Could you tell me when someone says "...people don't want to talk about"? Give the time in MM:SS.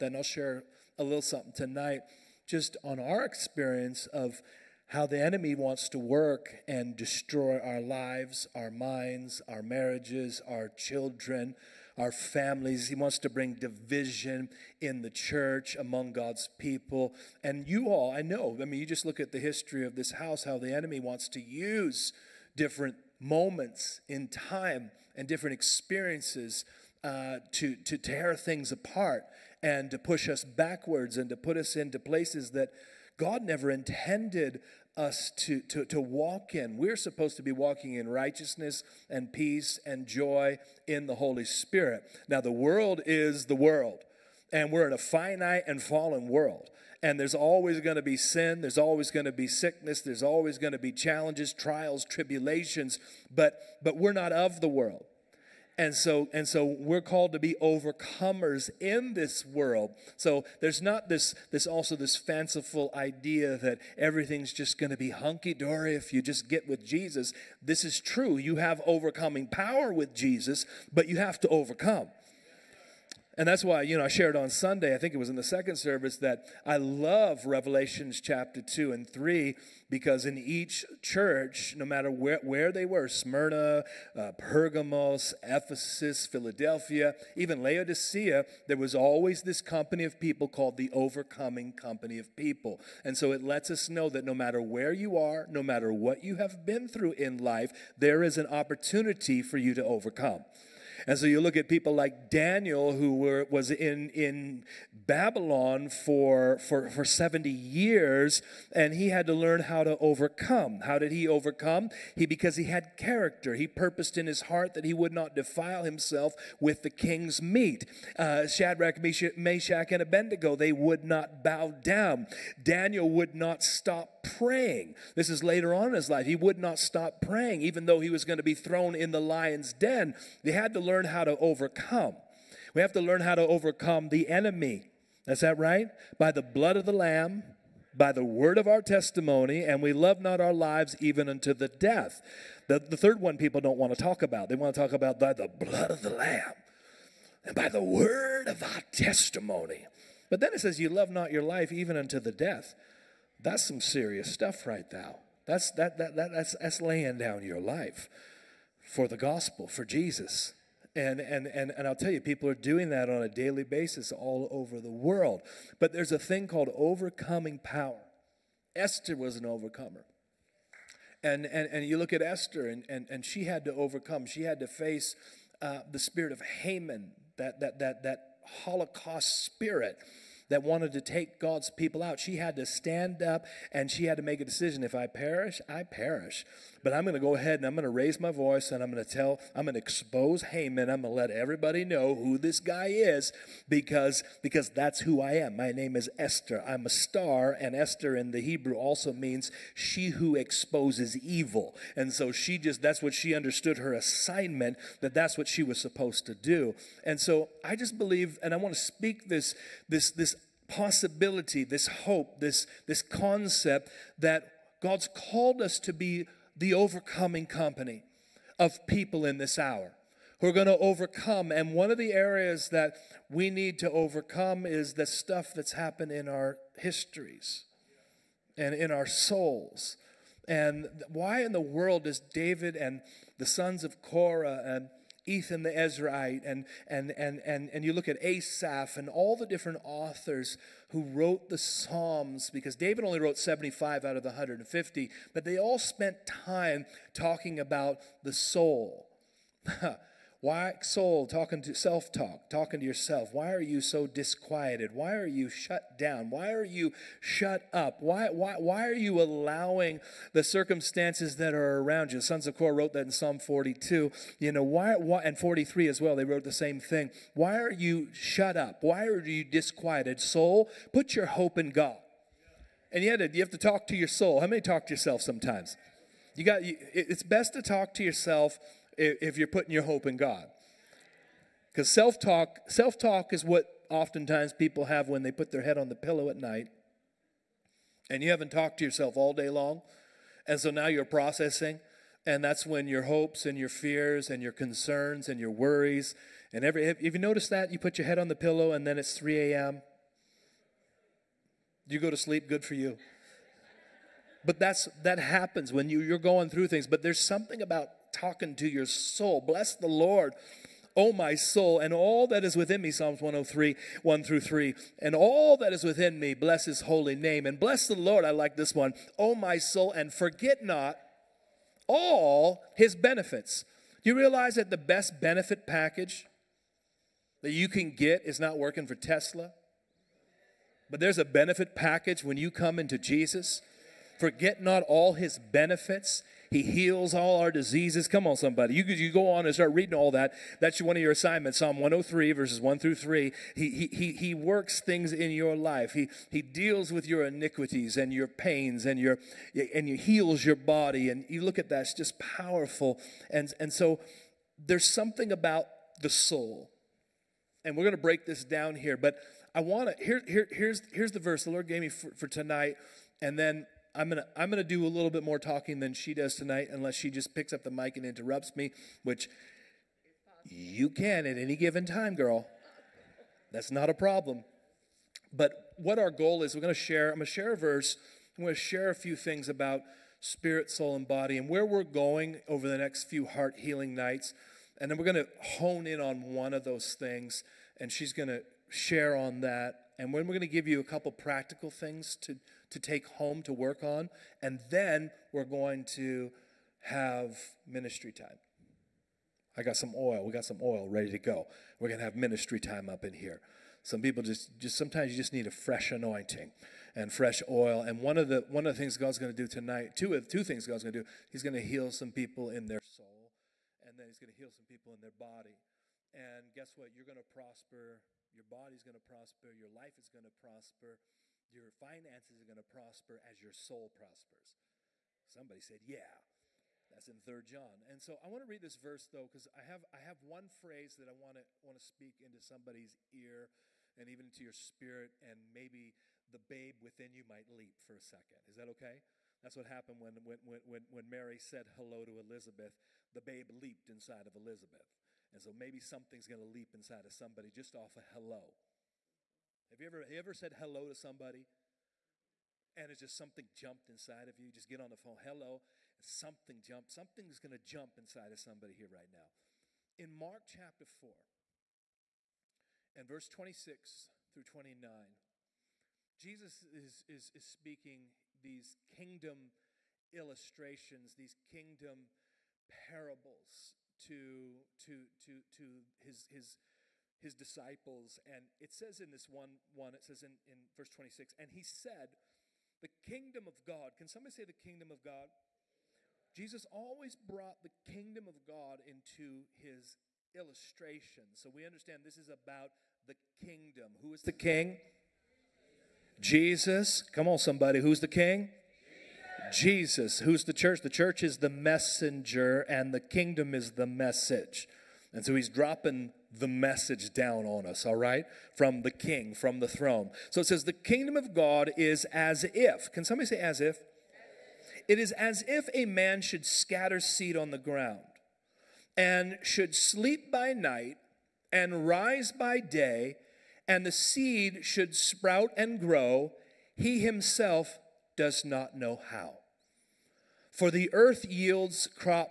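02:23.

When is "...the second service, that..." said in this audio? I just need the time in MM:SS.
01:15.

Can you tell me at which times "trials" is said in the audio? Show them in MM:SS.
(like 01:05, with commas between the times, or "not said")
00:51.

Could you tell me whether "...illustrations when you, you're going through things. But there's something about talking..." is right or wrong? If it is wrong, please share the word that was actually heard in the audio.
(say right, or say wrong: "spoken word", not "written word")
wrong: "happens", not "illustrations".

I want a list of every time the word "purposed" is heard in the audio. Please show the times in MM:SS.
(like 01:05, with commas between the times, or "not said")
01:53.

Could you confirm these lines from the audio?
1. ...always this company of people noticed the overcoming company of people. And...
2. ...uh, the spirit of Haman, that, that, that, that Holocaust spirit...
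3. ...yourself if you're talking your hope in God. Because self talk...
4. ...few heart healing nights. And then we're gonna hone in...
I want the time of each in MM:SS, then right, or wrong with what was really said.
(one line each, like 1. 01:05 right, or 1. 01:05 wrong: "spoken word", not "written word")
1. 01:28 wrong: "called", not "noticed"
2. 02:55 right
3. 04:38 wrong: "putting", not "talking"
4. 06:23 right.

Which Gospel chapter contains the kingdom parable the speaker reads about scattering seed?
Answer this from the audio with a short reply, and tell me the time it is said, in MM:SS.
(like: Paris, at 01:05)
Mark chapter 4, at 07:40.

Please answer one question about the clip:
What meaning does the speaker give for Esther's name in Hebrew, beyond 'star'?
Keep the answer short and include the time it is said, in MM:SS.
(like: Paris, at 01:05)
She who exposes evil, at 03:19.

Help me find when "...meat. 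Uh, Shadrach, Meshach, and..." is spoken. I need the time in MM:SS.
01:57.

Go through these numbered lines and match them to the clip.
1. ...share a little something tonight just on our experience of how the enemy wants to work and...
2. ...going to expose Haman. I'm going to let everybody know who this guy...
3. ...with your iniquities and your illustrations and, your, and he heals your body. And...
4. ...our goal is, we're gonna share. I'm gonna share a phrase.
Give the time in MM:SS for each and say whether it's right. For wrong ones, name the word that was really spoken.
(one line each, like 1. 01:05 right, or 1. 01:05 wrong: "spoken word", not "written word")
1. 00:00 right
2. 03:09 right
3. 05:46 wrong: "pains", not "illustrations"
4. 06:15 wrong: "verse", not "phrase".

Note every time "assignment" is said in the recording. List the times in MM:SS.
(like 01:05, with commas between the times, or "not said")
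03:23, 05:41.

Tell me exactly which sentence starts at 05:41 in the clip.
Psalm 103, verses 1 through 3.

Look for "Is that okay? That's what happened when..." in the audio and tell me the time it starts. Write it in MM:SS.
07:18.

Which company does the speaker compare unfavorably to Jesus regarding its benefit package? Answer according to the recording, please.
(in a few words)
Tesla.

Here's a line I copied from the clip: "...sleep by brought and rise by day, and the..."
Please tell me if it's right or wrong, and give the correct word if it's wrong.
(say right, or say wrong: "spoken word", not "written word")
wrong: "night", not "brought".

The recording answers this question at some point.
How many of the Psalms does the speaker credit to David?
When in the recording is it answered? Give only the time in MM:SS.
04:03.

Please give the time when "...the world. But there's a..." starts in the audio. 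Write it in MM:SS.
02:44.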